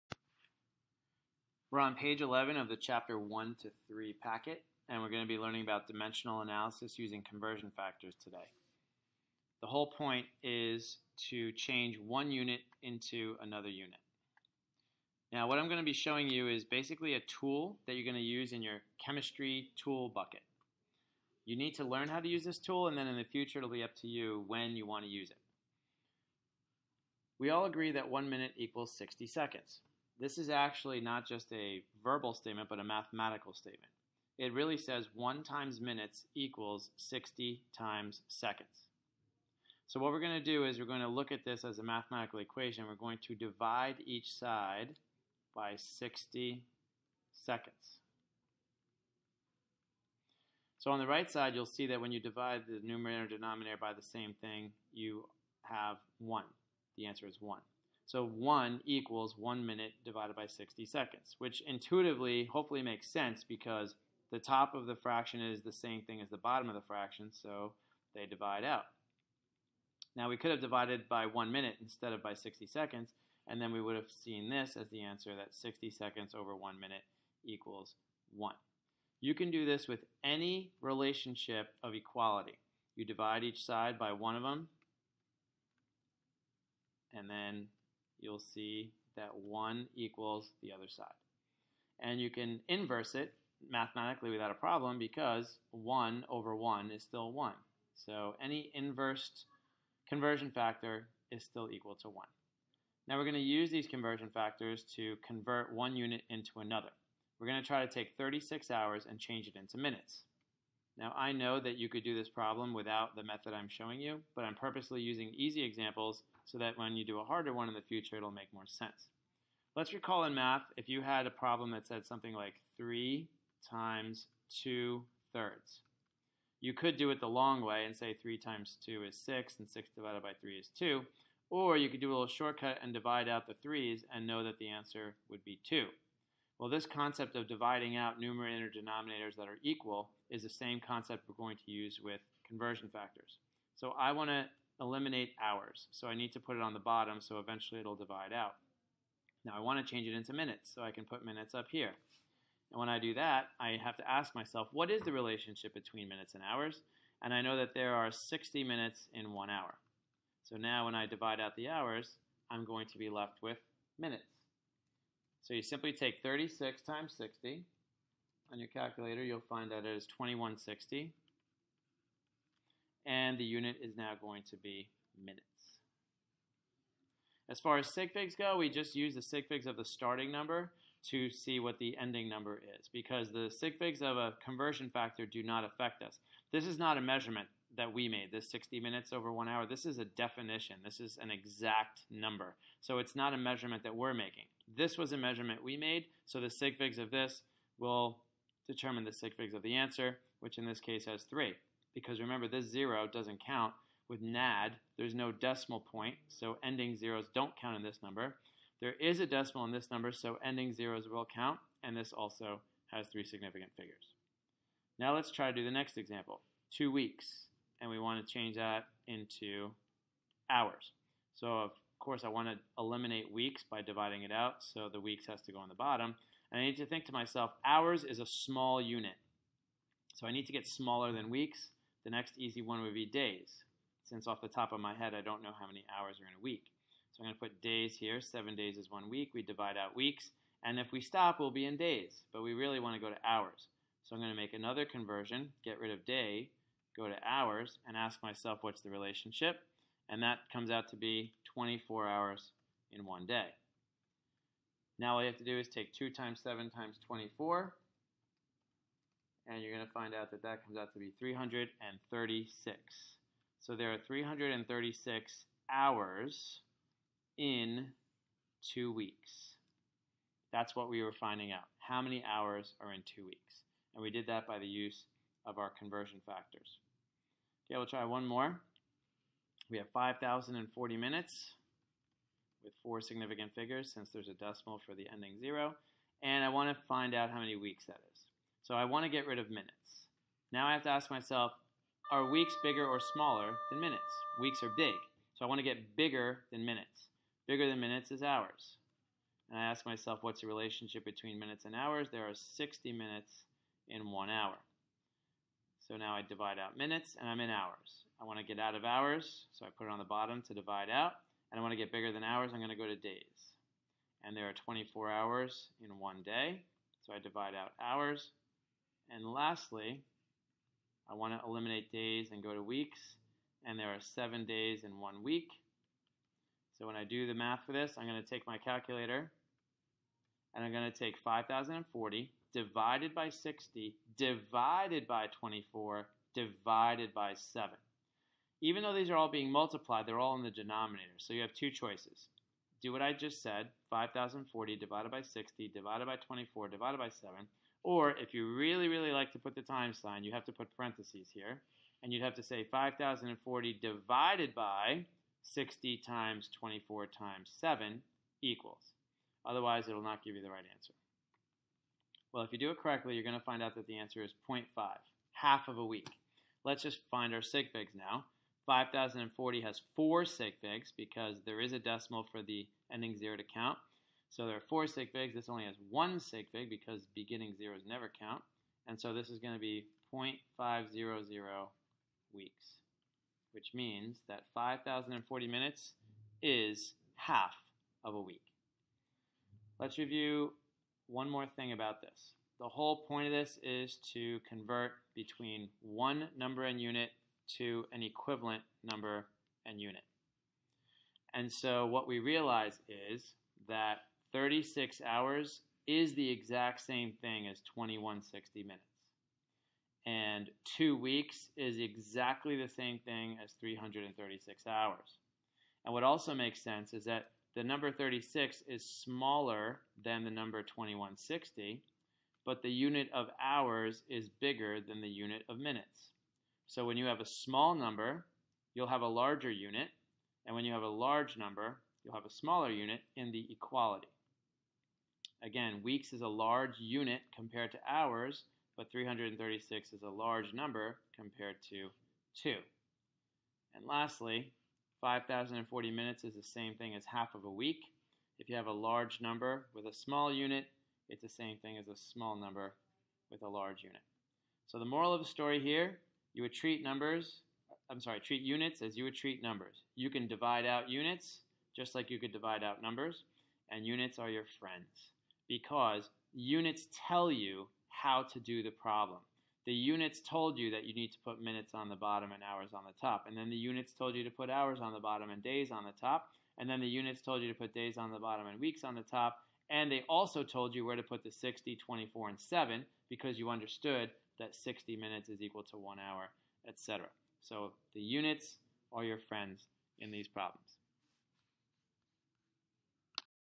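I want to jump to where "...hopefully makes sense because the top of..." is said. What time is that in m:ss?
1:02.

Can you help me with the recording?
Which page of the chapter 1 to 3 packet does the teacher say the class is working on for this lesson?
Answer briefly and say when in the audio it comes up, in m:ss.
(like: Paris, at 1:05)
11, at 0:01.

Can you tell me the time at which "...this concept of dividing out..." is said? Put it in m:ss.
2:16.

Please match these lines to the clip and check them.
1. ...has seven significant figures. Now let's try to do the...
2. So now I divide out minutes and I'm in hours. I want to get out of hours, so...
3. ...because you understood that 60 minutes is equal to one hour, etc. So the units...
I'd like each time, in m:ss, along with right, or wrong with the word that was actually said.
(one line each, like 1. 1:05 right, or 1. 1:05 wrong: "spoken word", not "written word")
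1. 3:32 wrong: "three", not "seven"
2. 5:05 right
3. 8:03 right.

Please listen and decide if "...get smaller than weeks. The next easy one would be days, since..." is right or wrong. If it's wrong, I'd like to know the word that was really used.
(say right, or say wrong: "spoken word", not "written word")
right.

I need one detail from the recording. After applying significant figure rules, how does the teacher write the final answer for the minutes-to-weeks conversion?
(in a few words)
0.500 weeks.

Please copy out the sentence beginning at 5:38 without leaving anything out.
Even though these are all being multiplied, they're all in the denominator.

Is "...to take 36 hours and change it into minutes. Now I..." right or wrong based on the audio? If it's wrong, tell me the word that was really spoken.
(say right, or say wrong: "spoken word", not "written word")
right.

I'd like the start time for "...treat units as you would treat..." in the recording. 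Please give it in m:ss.
7:38.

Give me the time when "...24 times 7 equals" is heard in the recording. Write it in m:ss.
5:56.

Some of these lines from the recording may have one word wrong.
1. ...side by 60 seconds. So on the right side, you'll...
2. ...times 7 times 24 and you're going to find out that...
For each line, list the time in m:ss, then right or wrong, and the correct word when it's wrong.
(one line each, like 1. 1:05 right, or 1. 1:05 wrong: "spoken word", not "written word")
1. 0:44 right
2. 4:16 right.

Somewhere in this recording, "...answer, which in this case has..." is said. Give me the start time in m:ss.
3:19.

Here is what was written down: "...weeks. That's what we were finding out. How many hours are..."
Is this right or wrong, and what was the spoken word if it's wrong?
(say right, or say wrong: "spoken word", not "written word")
right.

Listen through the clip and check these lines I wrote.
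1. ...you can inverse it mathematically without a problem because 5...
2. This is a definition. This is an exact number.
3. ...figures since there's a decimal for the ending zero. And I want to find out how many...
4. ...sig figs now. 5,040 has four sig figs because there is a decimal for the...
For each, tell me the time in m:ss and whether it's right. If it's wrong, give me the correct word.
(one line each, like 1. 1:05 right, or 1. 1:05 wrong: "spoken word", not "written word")
1. 1:32 wrong: "1", not "5"
2. 3:09 right
3. 4:43 right
4. 6:07 right.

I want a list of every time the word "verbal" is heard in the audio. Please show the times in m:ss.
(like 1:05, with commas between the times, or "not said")
0:32.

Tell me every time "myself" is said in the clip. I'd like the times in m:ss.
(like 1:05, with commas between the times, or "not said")
2:34, 3:47, 4:08, 4:51, 4:59.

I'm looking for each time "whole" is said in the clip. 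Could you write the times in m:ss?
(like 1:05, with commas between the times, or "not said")
0:09, 6:32.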